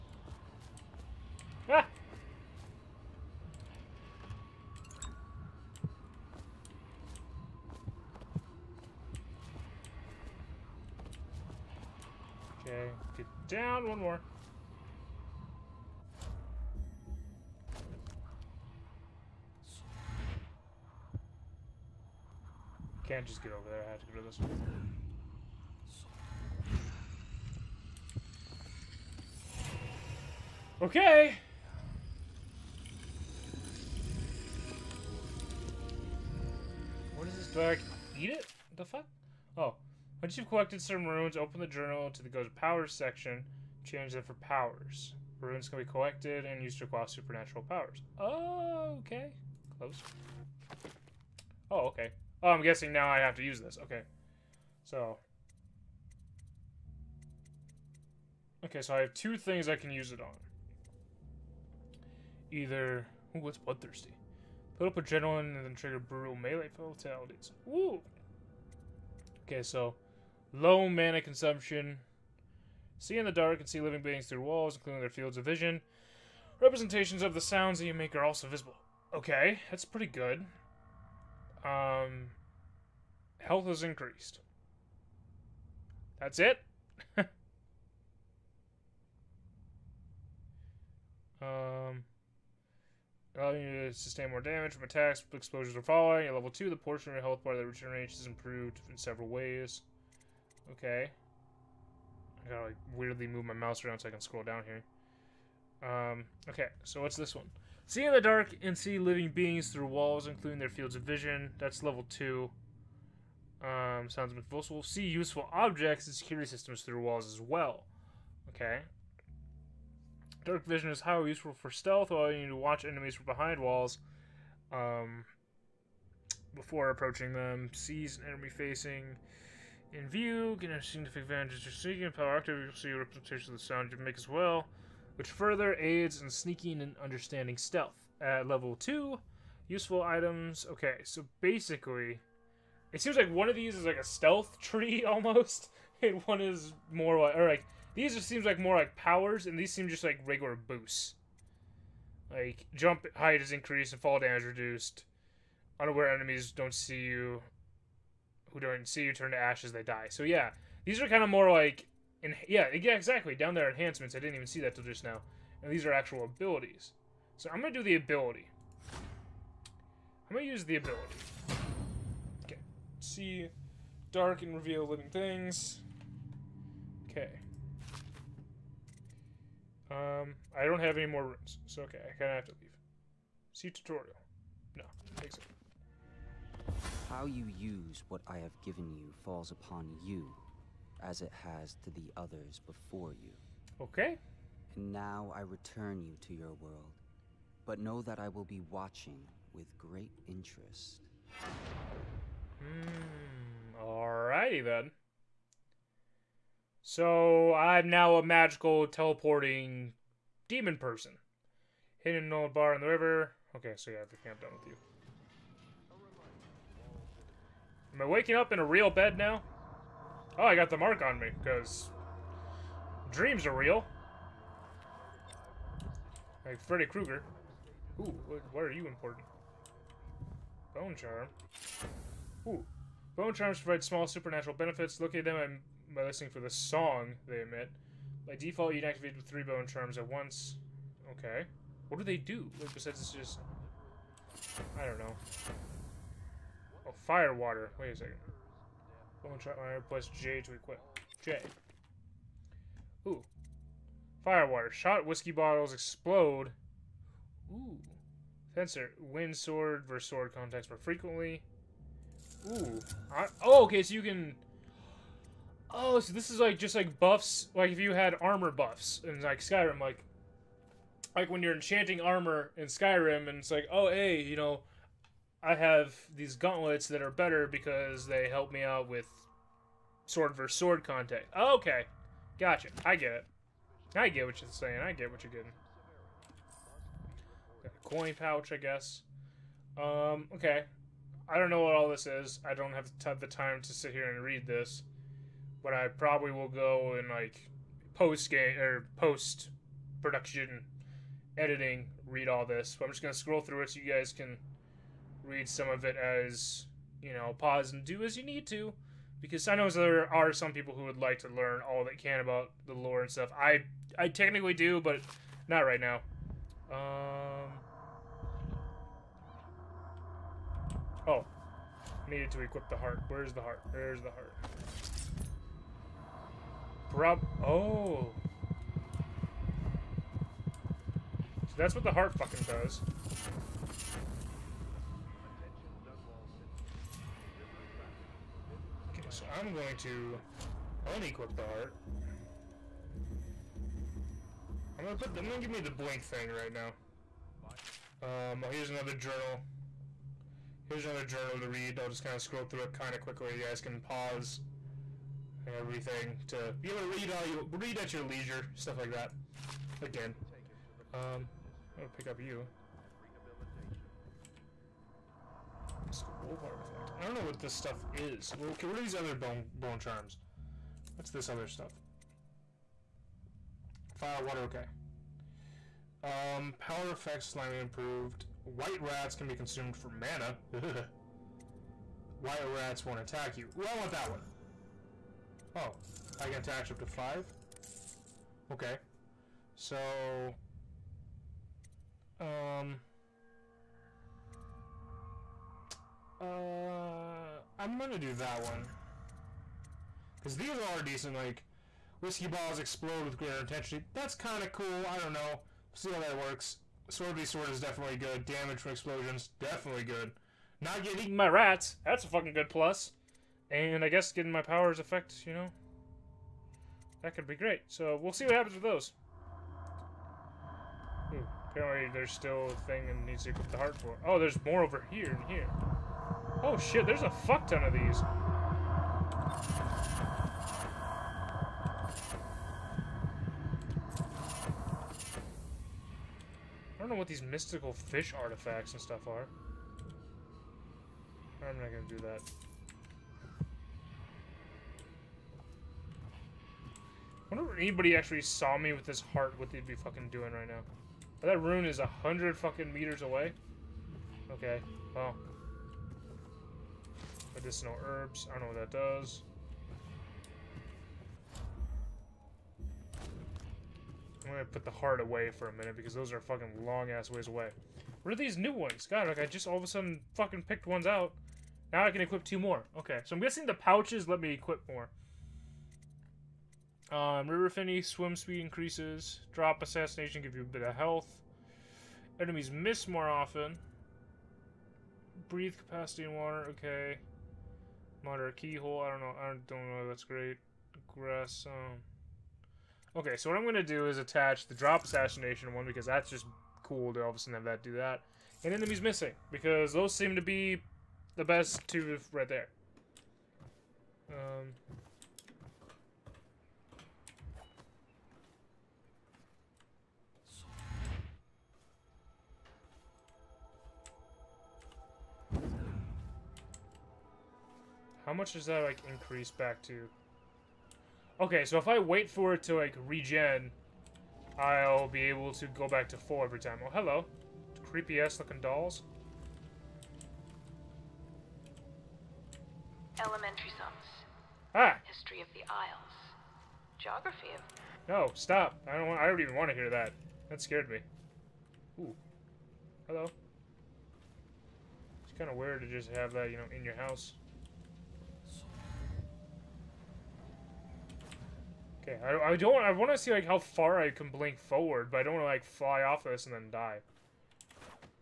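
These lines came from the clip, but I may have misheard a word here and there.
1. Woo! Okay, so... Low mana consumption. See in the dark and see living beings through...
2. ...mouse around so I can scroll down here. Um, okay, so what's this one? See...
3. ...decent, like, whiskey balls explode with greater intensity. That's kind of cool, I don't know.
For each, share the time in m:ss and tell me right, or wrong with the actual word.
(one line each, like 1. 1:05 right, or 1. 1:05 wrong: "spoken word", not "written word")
1. 1:07 right
2. 1:43 right
3. 6:40 right.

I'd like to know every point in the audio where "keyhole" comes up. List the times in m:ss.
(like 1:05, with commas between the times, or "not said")
8:08.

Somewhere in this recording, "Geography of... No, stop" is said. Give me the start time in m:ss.
8:56.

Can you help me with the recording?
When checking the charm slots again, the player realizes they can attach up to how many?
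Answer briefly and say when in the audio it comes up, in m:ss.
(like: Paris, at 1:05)
5, at 6:26.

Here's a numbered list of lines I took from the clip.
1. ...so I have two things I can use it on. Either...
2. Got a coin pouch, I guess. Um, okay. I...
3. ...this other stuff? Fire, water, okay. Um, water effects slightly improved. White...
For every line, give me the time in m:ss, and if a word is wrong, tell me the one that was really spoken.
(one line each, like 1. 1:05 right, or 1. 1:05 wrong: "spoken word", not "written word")
1. 0:58 right
2. 4:47 right
3. 6:11 wrong: "power", not "water".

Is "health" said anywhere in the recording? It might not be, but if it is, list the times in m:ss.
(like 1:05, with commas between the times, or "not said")
1:23, 1:37, 8:00.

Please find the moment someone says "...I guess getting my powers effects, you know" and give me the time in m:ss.
6:53.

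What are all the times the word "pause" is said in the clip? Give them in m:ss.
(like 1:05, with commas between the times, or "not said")
5:07, 5:53.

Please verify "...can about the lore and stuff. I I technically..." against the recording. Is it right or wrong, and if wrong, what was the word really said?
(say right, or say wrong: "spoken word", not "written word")
right.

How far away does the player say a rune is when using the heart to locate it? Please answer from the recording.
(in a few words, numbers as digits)
100 meters.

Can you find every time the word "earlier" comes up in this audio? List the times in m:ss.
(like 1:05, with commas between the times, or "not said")
not said.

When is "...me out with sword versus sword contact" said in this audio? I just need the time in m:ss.
4:38.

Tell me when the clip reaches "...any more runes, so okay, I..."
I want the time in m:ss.
3:00.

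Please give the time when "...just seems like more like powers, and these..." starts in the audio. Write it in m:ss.
2:28.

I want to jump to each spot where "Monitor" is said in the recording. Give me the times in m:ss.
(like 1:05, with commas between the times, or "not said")
8:08.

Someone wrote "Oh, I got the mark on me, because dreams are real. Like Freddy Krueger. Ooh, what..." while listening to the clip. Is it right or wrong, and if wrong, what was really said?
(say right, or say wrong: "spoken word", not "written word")
right.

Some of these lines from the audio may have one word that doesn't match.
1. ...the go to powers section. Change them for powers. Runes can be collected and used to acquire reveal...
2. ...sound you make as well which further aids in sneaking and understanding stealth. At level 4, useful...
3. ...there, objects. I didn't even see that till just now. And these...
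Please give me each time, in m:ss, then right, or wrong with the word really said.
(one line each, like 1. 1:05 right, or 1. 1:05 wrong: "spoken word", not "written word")
1. 0:42 wrong: "supernatural", not "reveal"
2. 2:13 wrong: "2", not "4"
3. 2:43 wrong: "enhancements", not "objects".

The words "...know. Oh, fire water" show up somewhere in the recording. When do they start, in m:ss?
4:04.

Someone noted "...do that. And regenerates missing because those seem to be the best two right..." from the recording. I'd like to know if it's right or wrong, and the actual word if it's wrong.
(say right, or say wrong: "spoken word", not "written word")
wrong: "enemies", not "regenerates".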